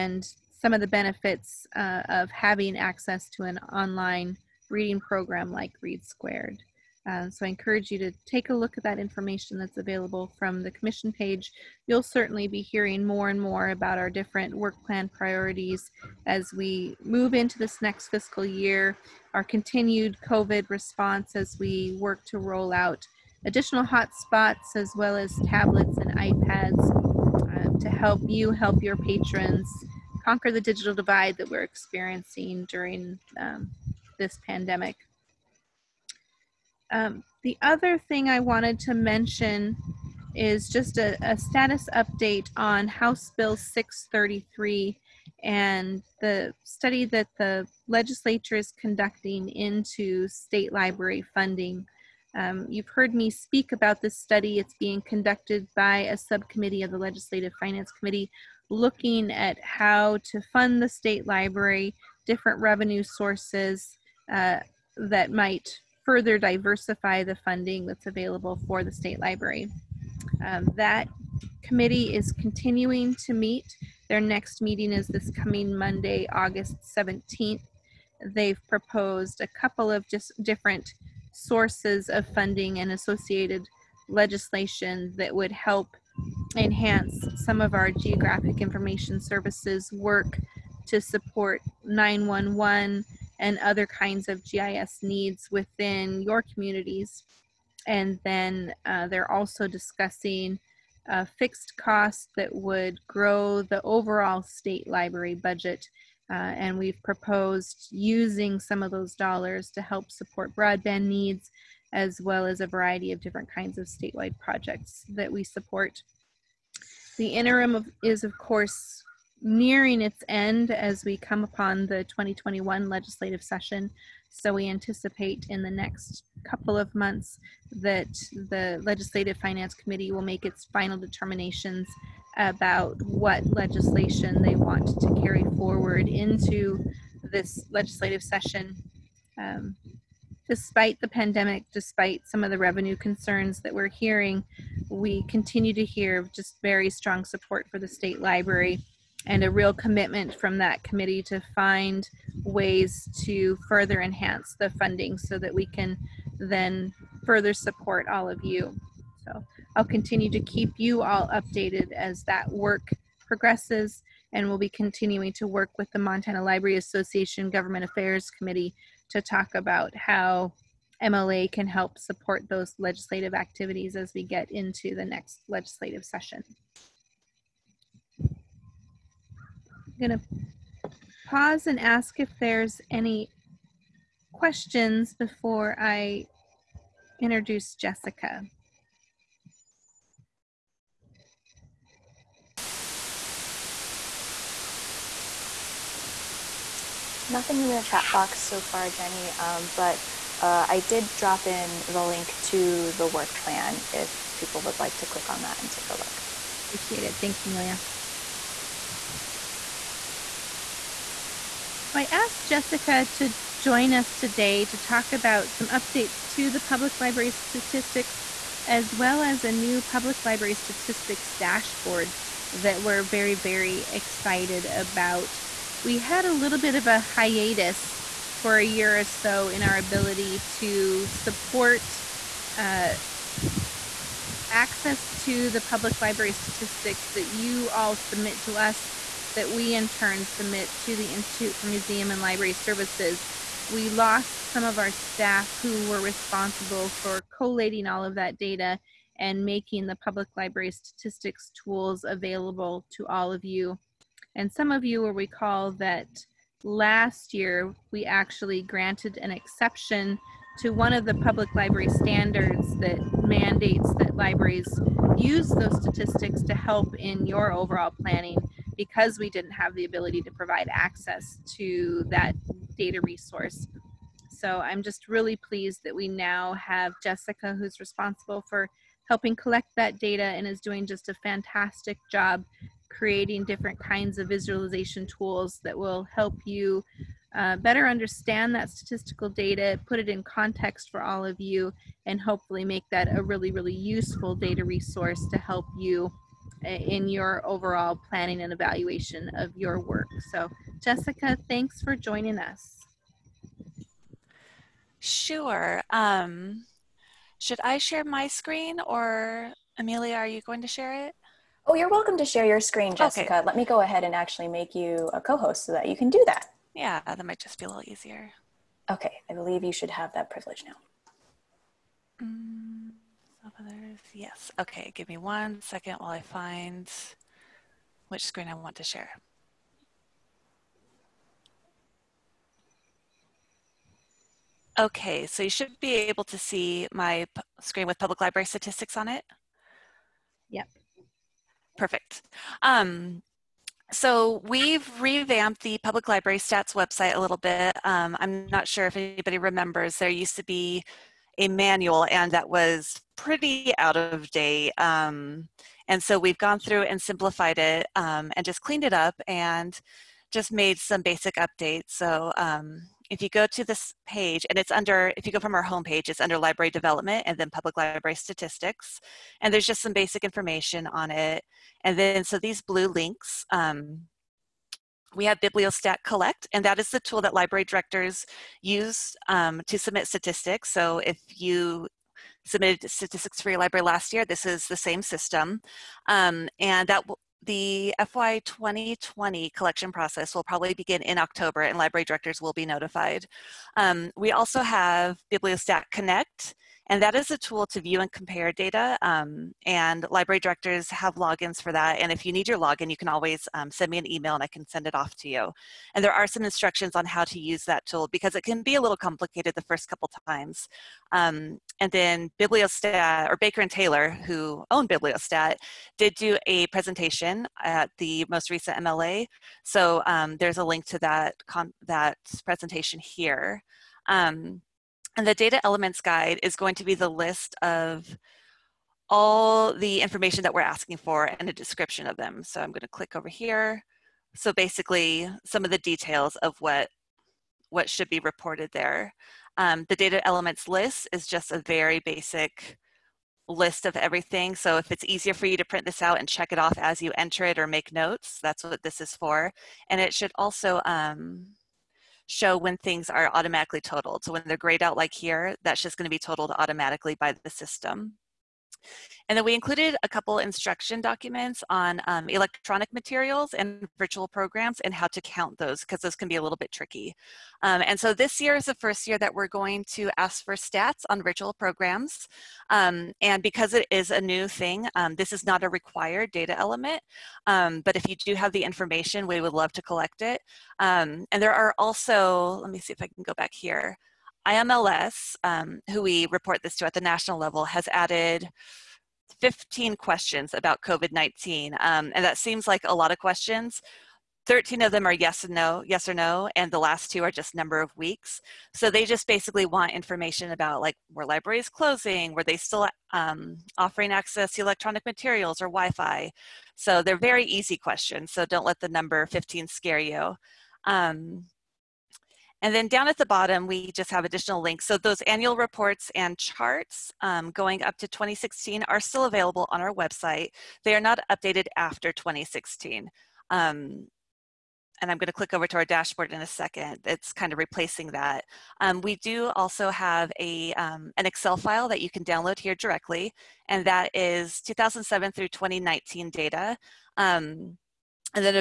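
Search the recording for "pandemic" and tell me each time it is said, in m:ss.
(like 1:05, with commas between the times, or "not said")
0:34, 2:21.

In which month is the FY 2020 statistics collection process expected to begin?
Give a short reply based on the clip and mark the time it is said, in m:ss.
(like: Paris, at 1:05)
October, at 6:31.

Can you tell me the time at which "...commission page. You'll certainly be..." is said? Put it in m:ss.
0:10.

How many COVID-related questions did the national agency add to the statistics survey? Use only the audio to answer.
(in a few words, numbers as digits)
15.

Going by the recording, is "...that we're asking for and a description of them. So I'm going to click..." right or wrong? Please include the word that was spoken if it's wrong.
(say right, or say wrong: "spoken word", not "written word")
right.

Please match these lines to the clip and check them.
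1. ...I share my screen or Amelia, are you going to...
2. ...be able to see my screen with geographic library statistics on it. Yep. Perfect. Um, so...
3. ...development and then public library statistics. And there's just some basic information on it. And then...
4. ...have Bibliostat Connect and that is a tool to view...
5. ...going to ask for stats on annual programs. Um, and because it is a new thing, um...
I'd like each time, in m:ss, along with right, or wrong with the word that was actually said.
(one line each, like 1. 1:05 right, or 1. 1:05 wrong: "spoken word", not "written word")
1. 5:07 right
2. 5:35 wrong: "public", not "geographic"
3. 6:06 right
4. 6:34 right
5. 7:49 wrong: "virtual", not "annual".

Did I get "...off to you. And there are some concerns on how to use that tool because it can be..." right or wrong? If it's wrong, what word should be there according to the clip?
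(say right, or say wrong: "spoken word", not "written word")
wrong: "instructions", not "concerns".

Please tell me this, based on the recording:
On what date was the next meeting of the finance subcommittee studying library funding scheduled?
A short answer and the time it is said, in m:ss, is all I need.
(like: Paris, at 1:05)
August 17th, at 1:16.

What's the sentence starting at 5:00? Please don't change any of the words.
So, Jessica, thanks for joining us.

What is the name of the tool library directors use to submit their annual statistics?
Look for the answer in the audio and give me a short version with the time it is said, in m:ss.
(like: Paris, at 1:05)
Bibliostat Collect, at 6:15.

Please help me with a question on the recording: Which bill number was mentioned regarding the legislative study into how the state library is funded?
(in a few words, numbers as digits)
633.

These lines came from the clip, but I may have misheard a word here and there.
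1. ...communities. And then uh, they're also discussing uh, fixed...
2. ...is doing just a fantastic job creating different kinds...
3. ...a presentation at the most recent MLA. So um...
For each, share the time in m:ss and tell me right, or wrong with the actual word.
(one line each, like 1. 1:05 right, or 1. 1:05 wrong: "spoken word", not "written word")
1. 1:36 right
2. 4:40 right
3. 6:56 right.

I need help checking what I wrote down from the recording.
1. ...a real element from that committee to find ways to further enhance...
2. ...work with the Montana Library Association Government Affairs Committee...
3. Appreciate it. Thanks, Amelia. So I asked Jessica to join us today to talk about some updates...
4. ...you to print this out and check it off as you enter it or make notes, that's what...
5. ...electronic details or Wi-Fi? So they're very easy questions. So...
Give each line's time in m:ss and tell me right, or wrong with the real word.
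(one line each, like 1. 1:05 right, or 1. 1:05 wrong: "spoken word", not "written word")
1. 2:29 wrong: "commitment", not "element"
2. 2:45 right
3. 3:26 right
4. 7:25 right
5. 8:24 wrong: "materials", not "details".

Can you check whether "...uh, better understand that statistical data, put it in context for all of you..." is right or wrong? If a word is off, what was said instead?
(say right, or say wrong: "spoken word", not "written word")
right.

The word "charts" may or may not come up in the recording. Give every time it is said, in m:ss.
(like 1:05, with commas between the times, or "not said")
8:36.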